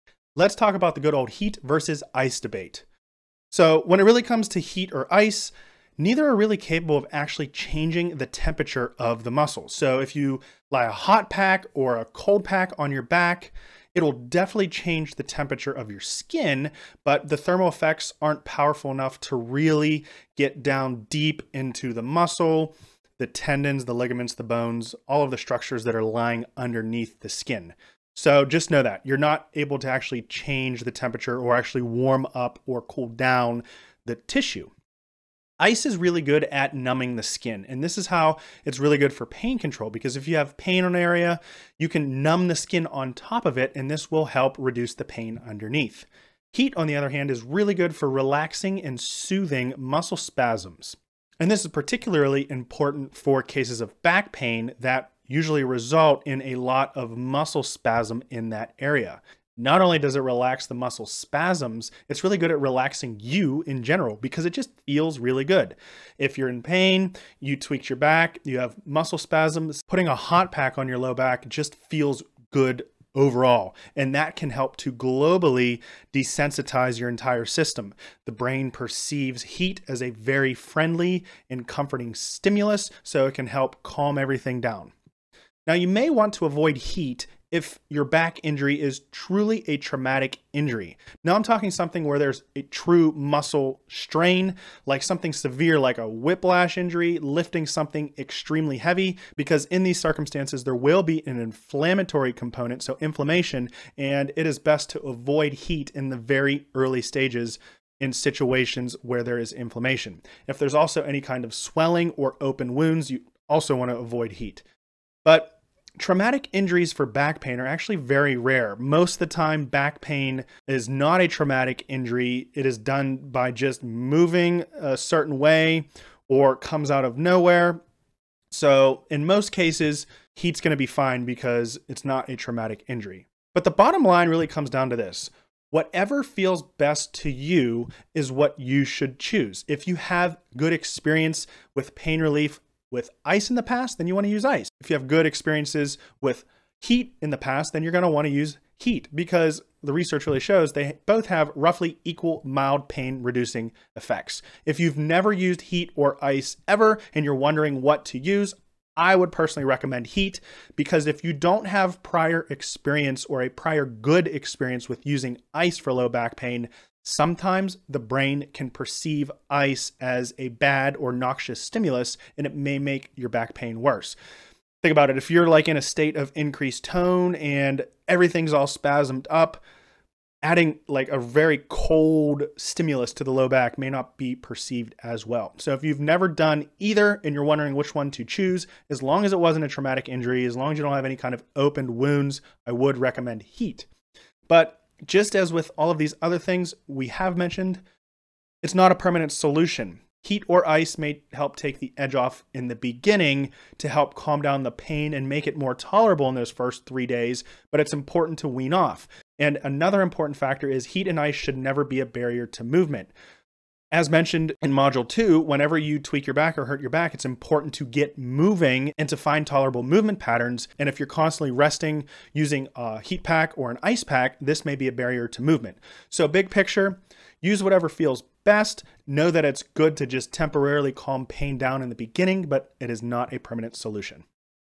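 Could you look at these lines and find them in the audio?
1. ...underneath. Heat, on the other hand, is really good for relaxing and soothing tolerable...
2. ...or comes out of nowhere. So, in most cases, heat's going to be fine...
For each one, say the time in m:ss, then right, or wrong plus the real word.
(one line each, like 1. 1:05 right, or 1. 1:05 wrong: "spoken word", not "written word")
1. 0:45 wrong: "muscle", not "tolerable"
2. 2:06 right.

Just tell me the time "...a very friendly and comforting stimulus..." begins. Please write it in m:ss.
1:20.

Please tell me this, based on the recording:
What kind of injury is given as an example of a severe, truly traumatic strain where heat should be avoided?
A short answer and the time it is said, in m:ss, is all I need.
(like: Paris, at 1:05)
Whiplash injury, at 1:36.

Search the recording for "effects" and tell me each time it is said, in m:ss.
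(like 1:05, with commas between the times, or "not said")
0:17, 2:33.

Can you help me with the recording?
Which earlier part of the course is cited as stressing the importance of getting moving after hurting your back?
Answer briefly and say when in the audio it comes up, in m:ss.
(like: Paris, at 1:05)
Module 2, at 3:34.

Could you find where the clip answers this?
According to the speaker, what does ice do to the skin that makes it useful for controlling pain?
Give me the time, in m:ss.
0:36.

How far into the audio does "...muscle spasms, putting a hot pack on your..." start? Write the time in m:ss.
1:08.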